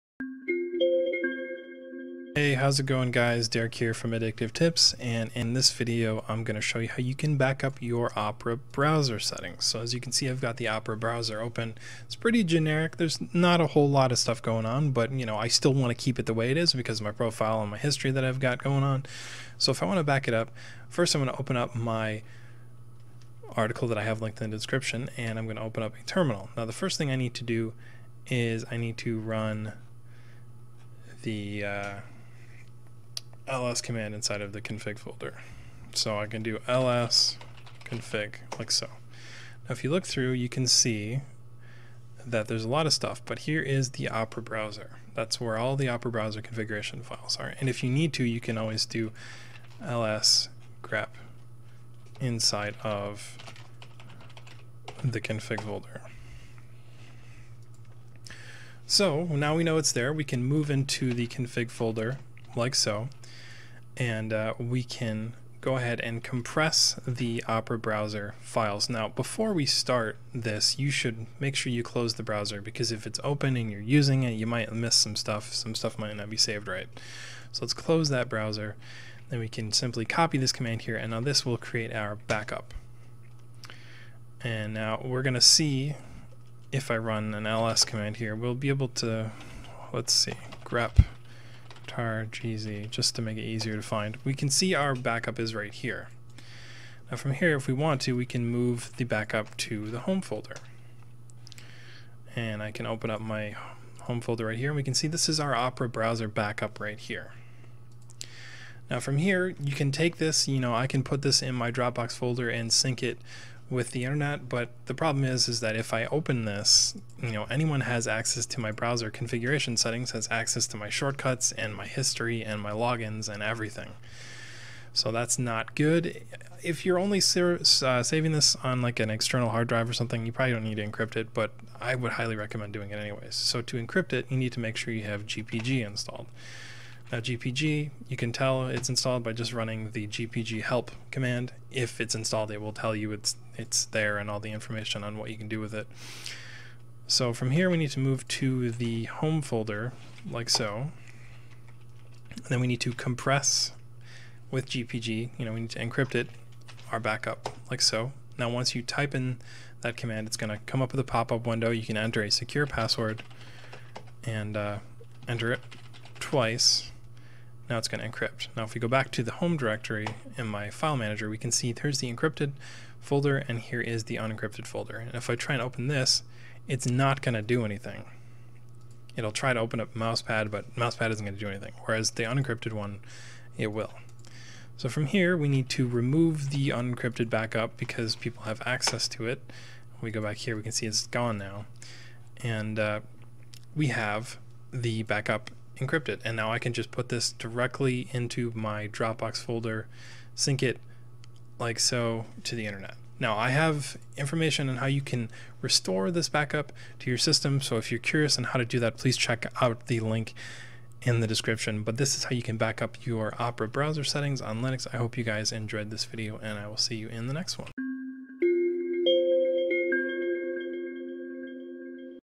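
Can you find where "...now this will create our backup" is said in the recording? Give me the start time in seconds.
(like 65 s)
81 s.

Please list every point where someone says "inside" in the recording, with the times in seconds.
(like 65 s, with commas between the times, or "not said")
34 s, 52 s.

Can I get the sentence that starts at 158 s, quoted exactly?
Now once you type in that command, it's going to come up with a pop-up window.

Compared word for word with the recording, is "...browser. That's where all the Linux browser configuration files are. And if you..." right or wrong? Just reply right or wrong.
wrong.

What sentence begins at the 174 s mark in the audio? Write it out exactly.
And if I try and open this, it's not going to do anything.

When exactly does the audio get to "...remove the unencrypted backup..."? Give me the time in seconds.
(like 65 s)
185 s.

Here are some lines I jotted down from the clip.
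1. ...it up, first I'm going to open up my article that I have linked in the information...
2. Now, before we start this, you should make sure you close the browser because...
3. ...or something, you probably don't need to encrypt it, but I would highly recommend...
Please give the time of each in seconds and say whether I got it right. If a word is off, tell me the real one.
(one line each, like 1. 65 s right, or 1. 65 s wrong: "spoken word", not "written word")
1. 20 s wrong: "description", not "information"
2. 68 s right
3. 129 s right.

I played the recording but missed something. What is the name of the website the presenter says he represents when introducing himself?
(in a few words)
Addictive Tips.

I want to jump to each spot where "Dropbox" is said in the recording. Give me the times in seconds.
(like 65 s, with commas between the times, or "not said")
111 s, 198 s.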